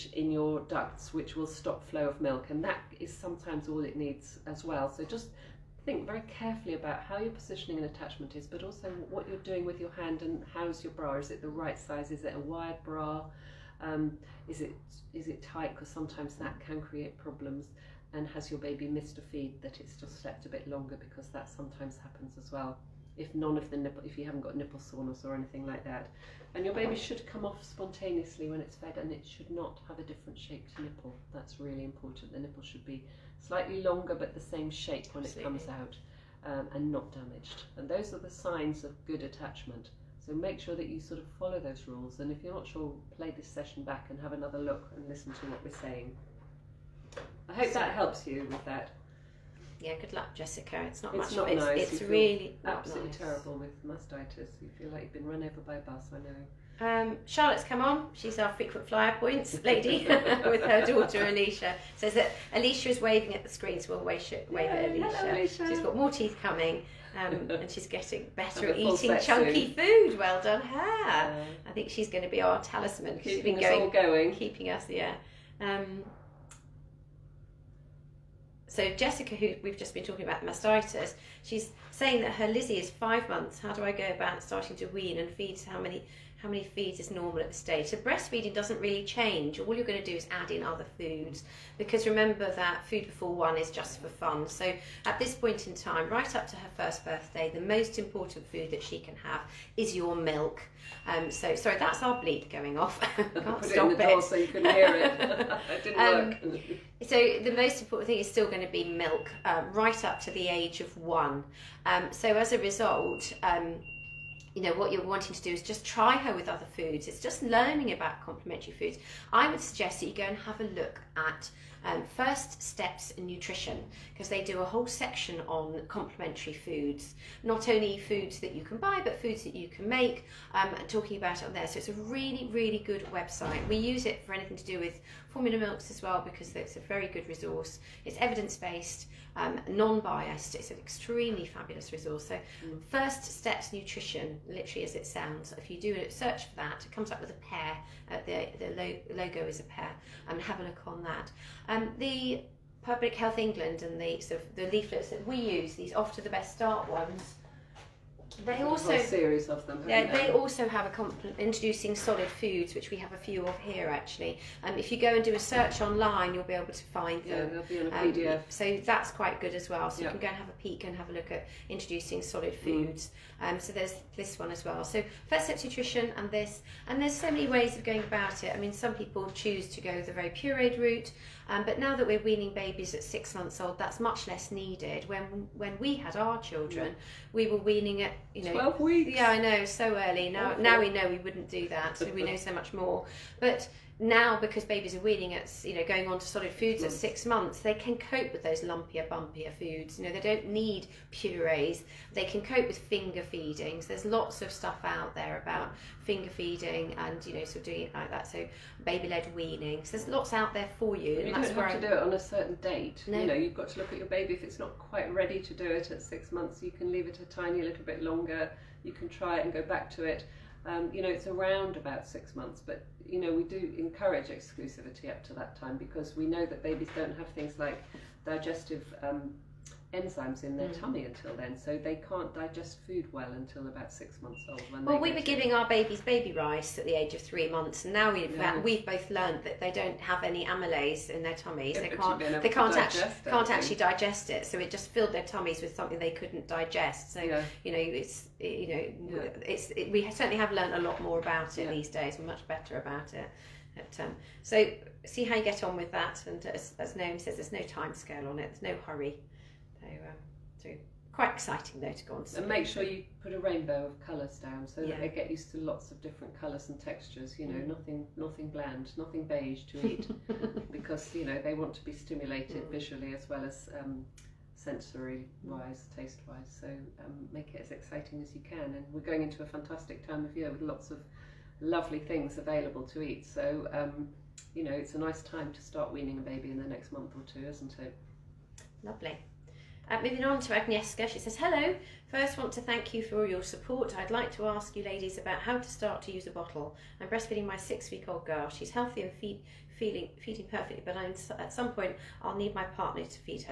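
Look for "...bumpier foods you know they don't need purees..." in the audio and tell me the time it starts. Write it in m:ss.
3:19.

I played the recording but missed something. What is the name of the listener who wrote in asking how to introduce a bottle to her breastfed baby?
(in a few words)
Agnieszka.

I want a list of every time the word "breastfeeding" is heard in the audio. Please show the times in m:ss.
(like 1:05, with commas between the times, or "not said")
1:27, 4:57.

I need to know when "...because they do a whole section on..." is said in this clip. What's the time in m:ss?
2:04.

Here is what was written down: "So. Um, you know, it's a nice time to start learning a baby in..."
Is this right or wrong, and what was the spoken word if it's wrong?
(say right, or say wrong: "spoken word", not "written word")
wrong: "weaning", not "learning".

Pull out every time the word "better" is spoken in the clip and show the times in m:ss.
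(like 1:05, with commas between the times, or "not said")
1:08, 4:12.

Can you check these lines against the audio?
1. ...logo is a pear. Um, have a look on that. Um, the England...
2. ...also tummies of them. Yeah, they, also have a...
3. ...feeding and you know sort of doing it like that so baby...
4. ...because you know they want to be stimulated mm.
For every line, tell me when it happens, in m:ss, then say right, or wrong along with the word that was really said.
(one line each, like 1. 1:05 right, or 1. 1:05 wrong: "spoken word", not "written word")
1. 2:29 wrong: "Public", not "England"
2. 2:38 wrong: "series", not "tummies"
3. 3:26 right
4. 4:30 right.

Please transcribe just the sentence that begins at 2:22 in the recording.
First Steps Nutrition, literally as it sounds.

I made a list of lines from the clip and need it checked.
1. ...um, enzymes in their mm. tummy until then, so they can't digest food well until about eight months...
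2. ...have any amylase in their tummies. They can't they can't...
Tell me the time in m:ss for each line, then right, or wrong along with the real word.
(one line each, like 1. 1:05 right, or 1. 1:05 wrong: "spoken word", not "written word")
1. 3:49 wrong: "six", not "eight"
2. 3:59 right.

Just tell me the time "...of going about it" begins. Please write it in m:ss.
2:57.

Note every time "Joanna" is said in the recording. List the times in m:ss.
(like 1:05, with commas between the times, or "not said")
not said.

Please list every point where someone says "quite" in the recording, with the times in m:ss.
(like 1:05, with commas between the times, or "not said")
2:49, 3:34, 4:21.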